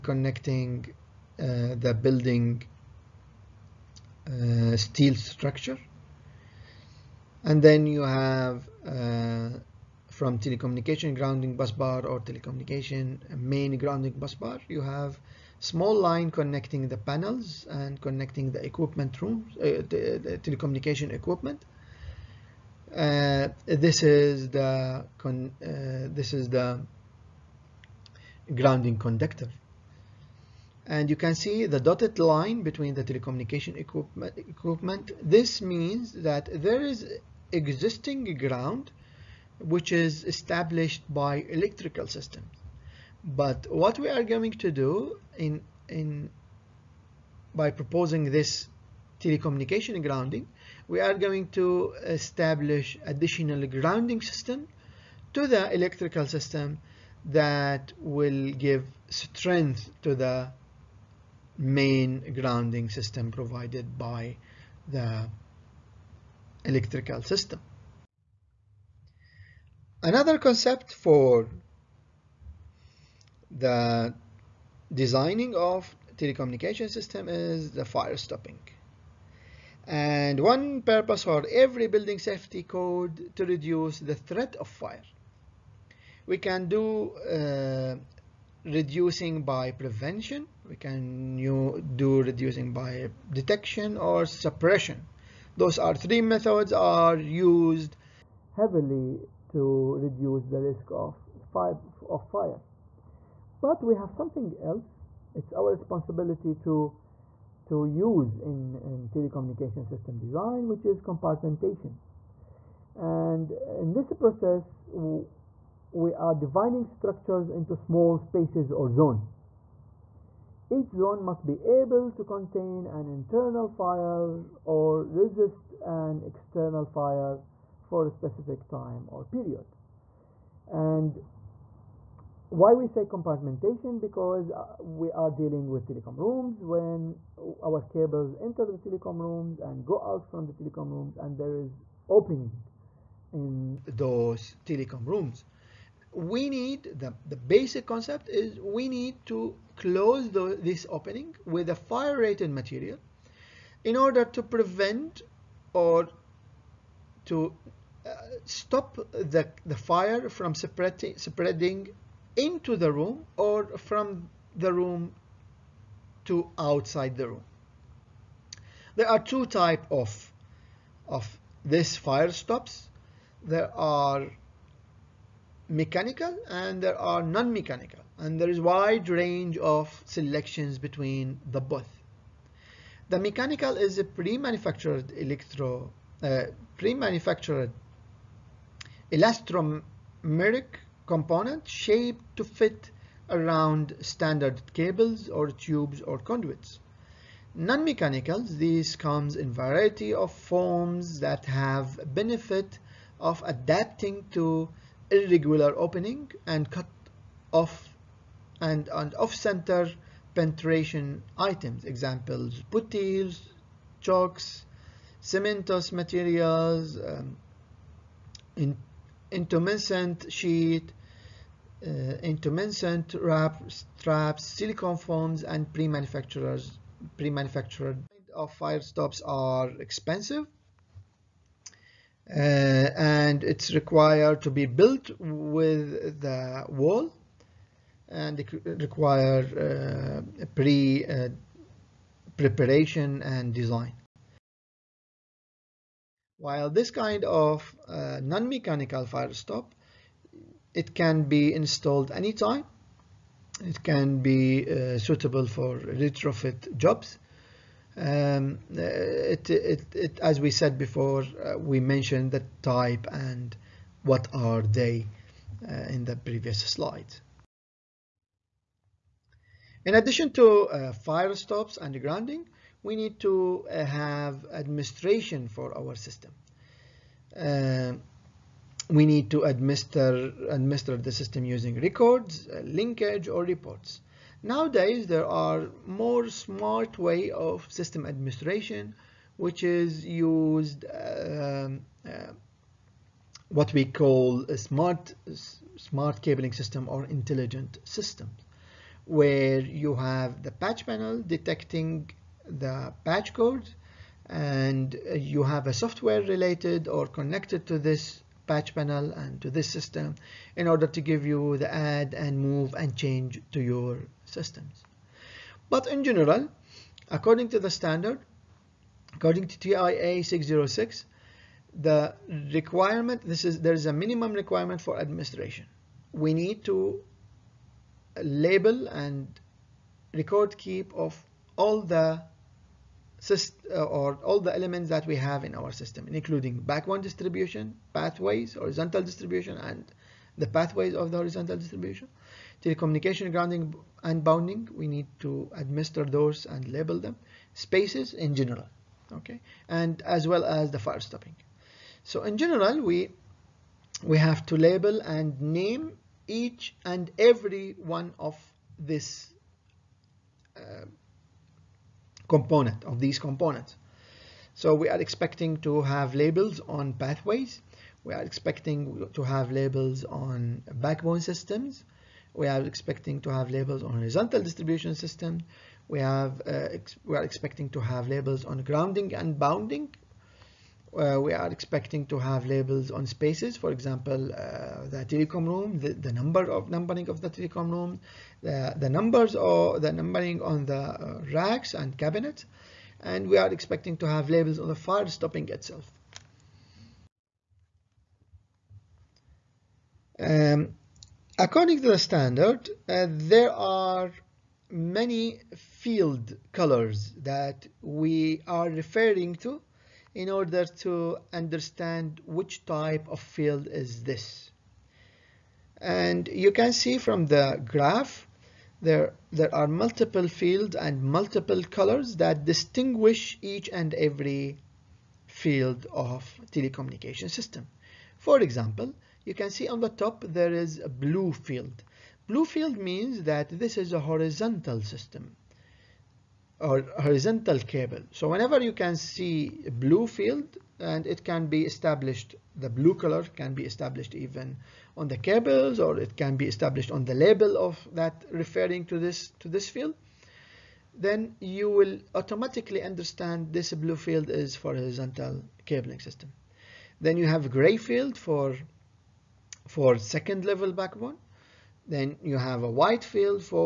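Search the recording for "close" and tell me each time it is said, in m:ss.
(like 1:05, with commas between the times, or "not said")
2:29.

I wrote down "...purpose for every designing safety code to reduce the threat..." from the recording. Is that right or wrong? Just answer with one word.
wrong.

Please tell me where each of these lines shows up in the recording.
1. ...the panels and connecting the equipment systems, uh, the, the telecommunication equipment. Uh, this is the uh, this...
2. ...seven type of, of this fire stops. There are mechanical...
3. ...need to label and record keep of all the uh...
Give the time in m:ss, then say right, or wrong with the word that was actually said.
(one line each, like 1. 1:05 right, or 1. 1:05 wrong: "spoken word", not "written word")
1. 0:16 wrong: "rooms", not "systems"
2. 2:49 wrong: "two", not "seven"
3. 5:26 right.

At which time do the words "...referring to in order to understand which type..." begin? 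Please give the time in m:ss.
6:48.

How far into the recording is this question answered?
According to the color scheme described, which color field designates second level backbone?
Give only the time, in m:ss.
7:37.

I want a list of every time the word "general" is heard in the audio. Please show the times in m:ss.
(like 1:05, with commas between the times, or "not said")
5:16, 5:48, 5:52.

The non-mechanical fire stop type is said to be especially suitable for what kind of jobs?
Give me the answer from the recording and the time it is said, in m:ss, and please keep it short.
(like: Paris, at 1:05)
retrofit jobs, at 4:15.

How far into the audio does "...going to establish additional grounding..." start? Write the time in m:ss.
0:51.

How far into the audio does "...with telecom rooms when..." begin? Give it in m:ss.
2:15.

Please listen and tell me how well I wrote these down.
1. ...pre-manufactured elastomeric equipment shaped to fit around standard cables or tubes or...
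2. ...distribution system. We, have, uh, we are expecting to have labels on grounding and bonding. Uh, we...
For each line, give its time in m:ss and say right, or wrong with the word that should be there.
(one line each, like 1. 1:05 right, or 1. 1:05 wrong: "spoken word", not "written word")
1. 3:06 wrong: "component", not "equipment"
2. 6:14 right.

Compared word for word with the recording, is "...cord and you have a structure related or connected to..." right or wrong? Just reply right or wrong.
wrong.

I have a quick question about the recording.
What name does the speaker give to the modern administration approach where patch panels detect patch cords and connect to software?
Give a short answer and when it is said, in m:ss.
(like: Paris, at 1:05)
intelligent system, at 4:57.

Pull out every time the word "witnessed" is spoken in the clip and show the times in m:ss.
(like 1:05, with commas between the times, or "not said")
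not said.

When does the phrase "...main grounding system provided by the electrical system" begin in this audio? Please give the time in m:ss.
1:01.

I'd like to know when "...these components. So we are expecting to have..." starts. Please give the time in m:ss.
6:03.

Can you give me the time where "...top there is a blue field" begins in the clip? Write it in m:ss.
7:09.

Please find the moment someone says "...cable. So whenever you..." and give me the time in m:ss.
7:17.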